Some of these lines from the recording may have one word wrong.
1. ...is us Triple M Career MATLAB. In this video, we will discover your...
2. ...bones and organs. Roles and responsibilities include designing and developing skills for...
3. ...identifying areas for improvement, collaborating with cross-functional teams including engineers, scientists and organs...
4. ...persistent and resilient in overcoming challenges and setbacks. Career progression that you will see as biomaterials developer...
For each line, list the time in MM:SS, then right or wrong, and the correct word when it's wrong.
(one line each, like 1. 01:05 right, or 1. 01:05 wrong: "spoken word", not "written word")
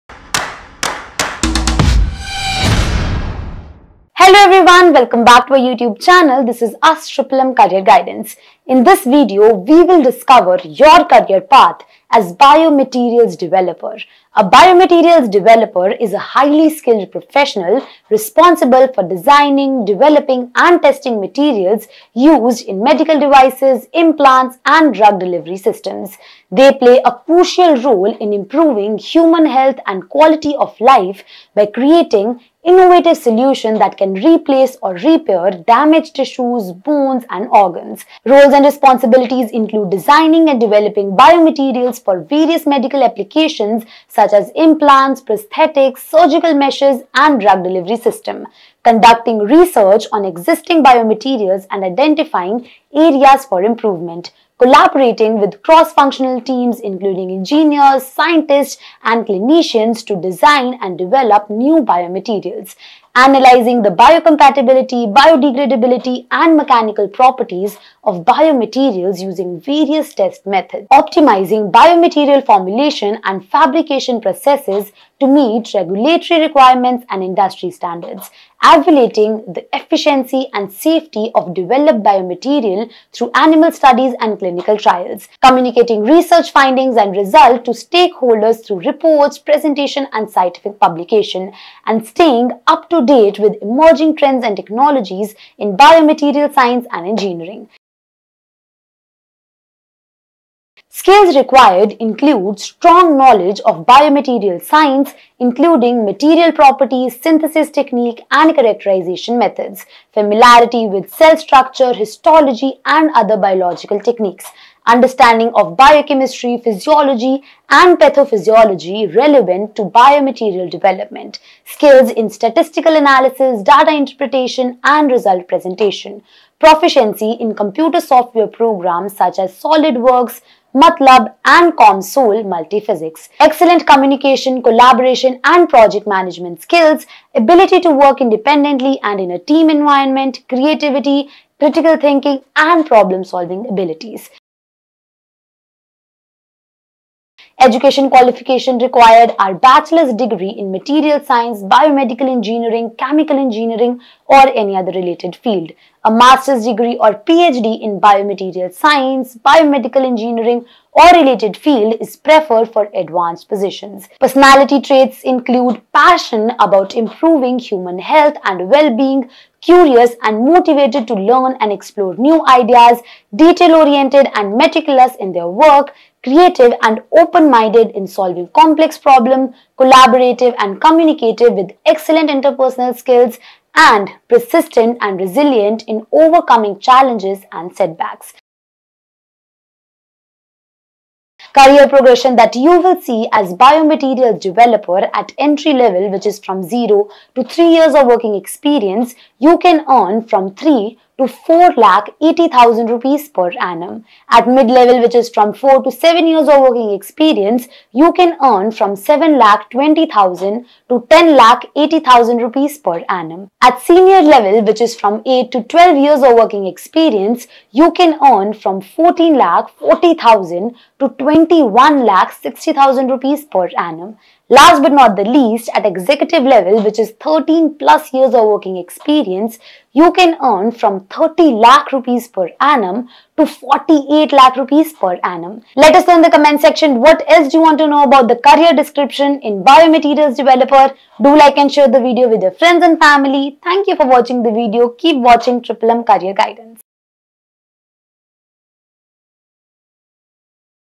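1. 00:06 wrong: "Guidance", not "MATLAB"
2. 00:36 wrong: "biomaterials", not "skills"
3. 00:51 wrong: "clinicians", not "organs"
4. 03:04 right.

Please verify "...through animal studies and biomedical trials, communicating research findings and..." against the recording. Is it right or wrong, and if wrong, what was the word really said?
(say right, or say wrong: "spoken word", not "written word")
wrong: "clinical", not "biomedical".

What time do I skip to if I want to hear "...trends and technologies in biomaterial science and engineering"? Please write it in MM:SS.
01:34.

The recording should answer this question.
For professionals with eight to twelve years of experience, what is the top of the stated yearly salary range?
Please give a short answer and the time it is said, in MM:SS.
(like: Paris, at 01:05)
21 lakh 60,000 rupees, at 03:41.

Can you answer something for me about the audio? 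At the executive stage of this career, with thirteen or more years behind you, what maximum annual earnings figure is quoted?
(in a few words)
48 lakh rupees.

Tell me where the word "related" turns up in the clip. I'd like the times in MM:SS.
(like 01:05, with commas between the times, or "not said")
02:34, 02:41.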